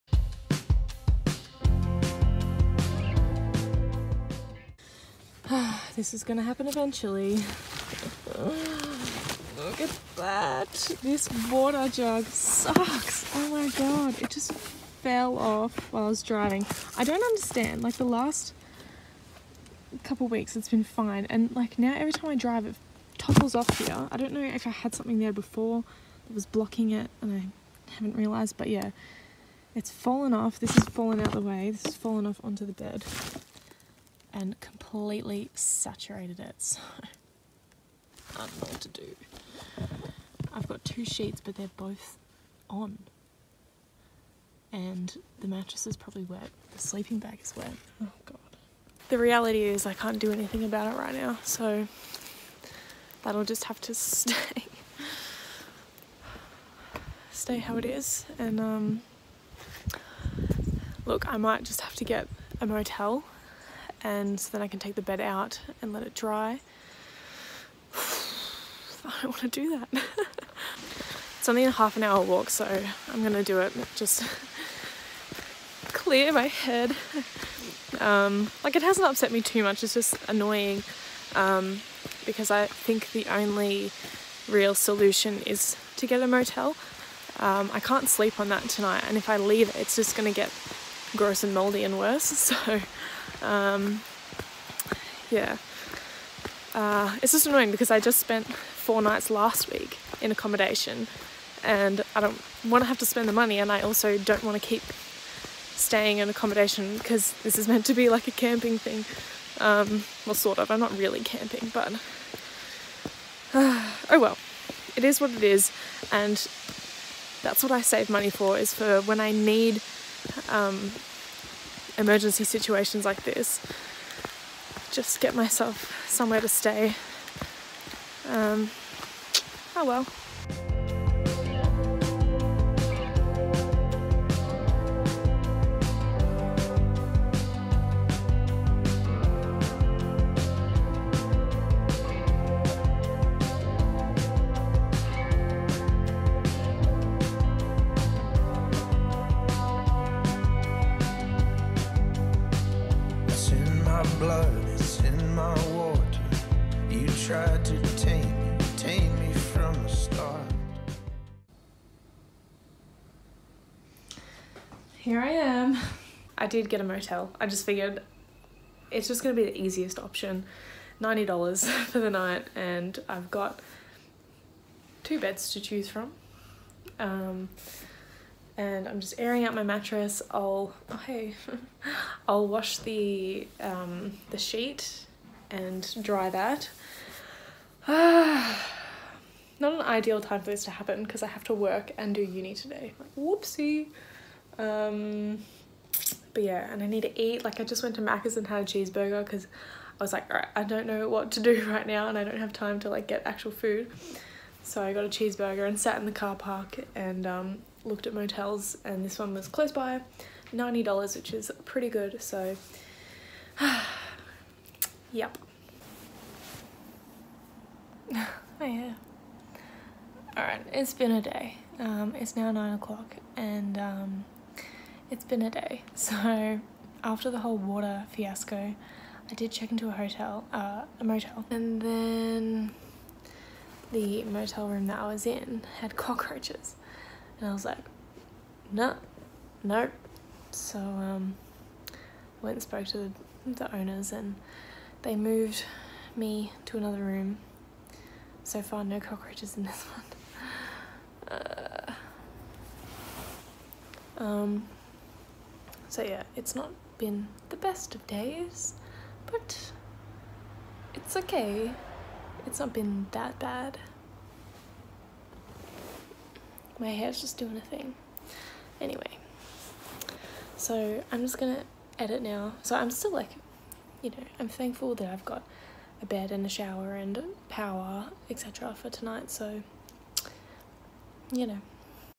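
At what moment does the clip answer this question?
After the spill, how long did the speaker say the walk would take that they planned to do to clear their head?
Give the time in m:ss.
1:11.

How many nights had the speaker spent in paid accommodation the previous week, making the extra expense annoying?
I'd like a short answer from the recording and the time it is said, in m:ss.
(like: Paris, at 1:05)
4, at 1:38.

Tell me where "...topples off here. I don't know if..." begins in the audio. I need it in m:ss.
0:23.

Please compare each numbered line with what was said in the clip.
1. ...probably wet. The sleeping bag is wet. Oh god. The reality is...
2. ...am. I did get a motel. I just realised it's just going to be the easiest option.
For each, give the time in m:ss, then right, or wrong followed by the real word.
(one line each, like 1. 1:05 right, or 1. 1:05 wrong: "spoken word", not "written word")
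1. 0:45 right
2. 2:45 wrong: "figured", not "realised".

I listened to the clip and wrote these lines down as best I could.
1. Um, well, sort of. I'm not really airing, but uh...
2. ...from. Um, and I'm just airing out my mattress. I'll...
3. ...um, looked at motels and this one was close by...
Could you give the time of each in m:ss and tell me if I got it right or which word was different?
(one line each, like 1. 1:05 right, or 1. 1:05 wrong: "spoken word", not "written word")
1. 1:49 wrong: "camping", not "airing"
2. 2:55 right
3. 3:27 right.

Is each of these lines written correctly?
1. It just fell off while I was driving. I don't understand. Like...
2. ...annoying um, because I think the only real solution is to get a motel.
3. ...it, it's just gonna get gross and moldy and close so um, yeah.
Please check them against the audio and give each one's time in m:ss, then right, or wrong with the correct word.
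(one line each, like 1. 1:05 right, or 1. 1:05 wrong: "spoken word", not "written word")
1. 0:14 right
2. 1:20 right
3. 1:29 wrong: "worse", not "close".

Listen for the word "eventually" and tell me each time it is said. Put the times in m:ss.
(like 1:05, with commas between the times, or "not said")
0:06.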